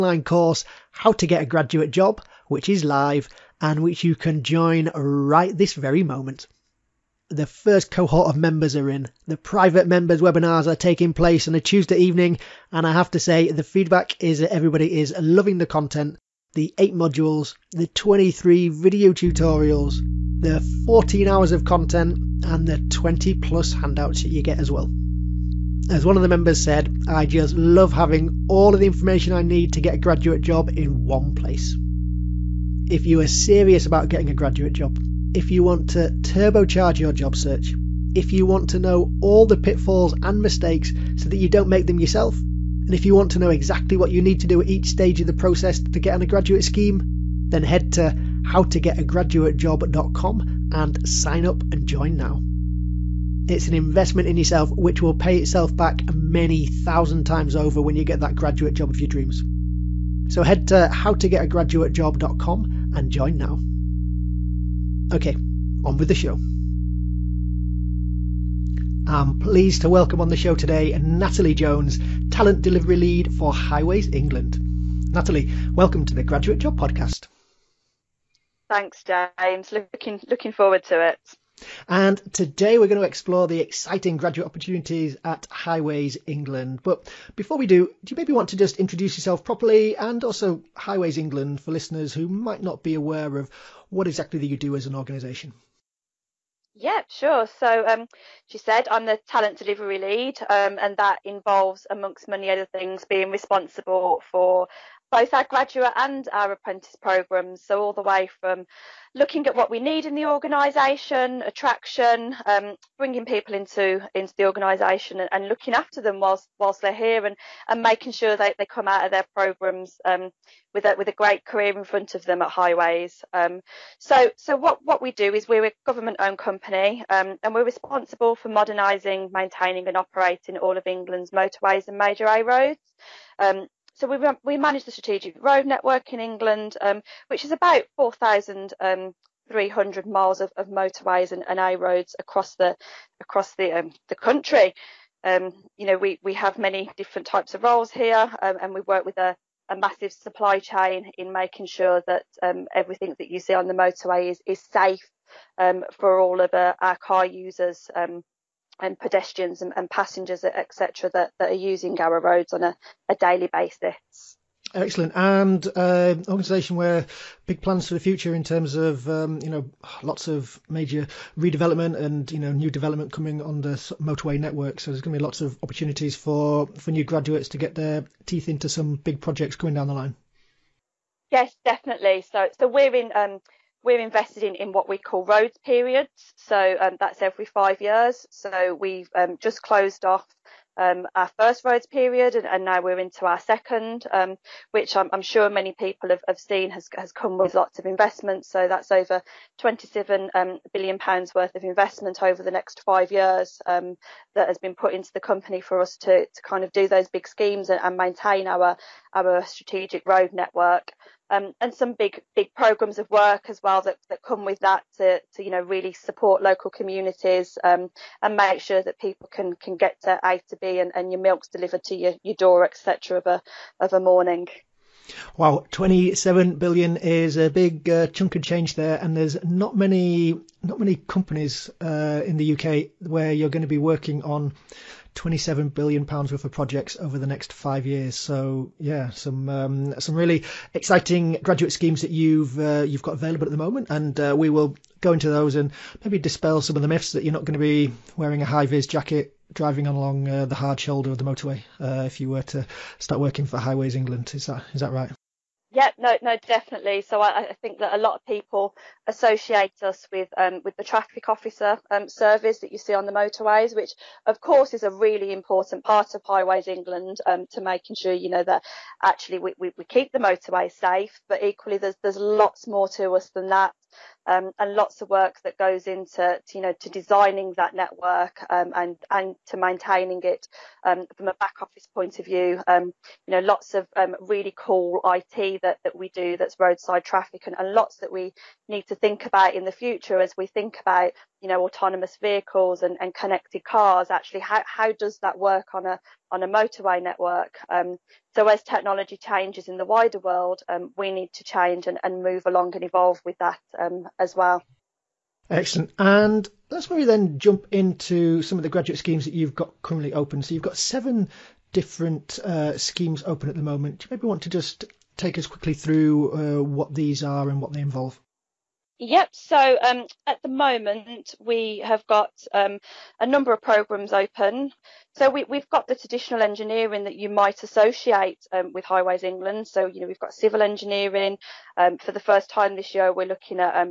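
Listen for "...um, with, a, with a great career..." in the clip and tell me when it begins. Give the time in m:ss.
2:00.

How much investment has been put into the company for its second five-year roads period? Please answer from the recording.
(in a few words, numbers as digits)
27 billion pounds.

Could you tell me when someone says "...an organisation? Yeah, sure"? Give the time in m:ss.
1:34.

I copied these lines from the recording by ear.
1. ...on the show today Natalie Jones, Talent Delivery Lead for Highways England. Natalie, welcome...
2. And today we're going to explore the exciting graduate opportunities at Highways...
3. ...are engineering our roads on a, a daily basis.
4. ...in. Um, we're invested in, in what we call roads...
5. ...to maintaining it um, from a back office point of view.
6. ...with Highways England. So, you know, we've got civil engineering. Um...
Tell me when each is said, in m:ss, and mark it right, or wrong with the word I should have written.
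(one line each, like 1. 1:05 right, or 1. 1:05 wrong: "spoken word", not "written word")
1. 1:10 right
2. 1:21 right
3. 2:41 wrong: "using", not "engineering"
4. 3:02 right
5. 4:39 right
6. 5:28 right.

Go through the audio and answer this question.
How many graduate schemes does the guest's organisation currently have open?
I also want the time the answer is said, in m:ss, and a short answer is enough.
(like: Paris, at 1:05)
7, at 5:10.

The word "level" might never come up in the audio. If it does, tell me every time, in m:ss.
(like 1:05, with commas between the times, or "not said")
not said.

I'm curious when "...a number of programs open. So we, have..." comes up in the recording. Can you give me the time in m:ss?
5:23.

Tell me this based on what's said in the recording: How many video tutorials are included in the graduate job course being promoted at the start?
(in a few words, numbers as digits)
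23.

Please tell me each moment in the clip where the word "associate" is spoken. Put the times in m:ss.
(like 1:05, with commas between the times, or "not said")
4:19, 5:27.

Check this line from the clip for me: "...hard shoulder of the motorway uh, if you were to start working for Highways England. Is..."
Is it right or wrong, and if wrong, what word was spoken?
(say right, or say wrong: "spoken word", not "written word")
right.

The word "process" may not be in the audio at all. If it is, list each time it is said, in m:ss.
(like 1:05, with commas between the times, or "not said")
0:45.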